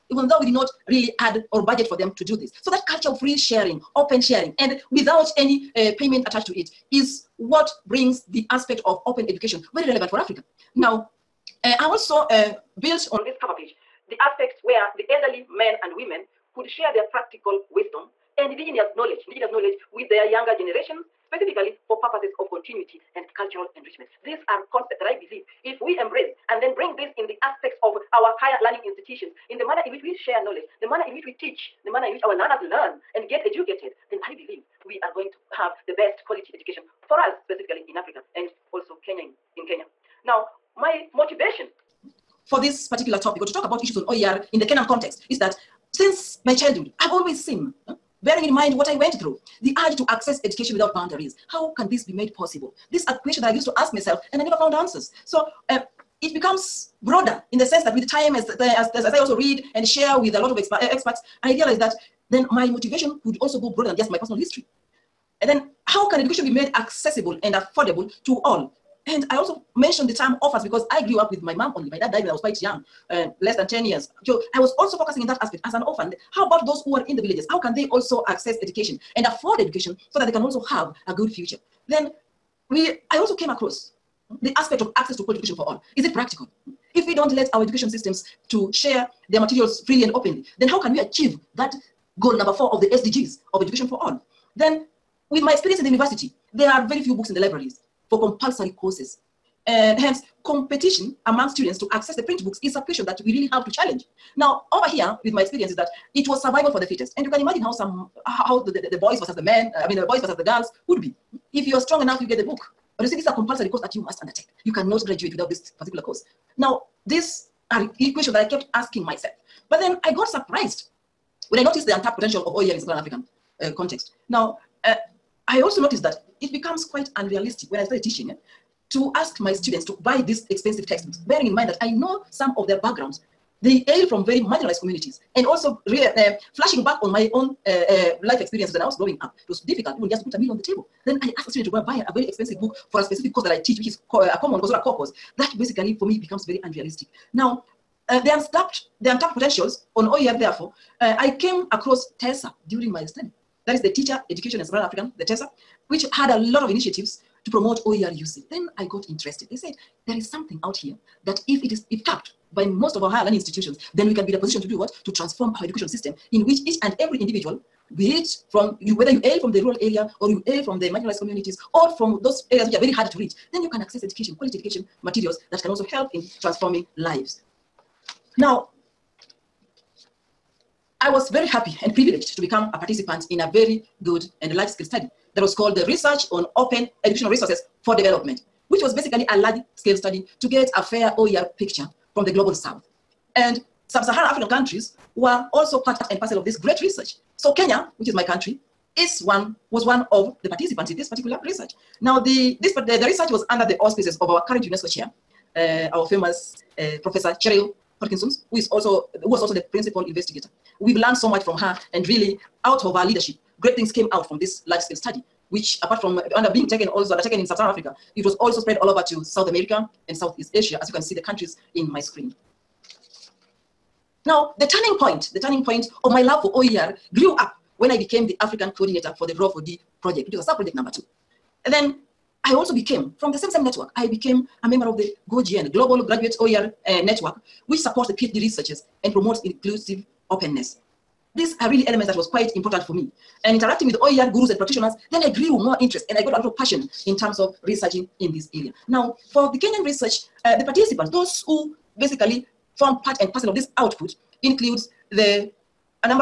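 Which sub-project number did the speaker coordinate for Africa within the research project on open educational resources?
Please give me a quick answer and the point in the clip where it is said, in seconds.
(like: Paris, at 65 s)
2, at 230 s.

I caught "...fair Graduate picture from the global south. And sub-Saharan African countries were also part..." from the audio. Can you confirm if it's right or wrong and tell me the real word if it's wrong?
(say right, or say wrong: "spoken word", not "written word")
wrong: "OER", not "Graduate".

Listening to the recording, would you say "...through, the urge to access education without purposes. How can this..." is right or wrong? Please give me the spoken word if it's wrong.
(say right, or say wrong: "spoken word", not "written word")
wrong: "boundaries", not "purposes".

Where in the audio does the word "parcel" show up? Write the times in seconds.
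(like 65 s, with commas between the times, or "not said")
196 s, 253 s.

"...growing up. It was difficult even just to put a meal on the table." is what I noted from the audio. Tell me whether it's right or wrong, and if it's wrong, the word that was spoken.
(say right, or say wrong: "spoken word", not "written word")
right.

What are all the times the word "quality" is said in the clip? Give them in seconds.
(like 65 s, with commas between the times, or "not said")
36 s, 85 s, 174 s.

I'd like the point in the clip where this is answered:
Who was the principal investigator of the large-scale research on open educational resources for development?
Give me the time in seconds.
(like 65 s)
207 s.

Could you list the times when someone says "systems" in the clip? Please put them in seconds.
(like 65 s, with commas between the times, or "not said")
87 s, 165 s.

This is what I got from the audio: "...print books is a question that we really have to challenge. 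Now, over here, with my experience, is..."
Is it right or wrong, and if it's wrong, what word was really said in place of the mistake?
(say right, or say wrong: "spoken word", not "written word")
right.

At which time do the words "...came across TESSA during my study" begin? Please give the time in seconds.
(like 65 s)
151 s.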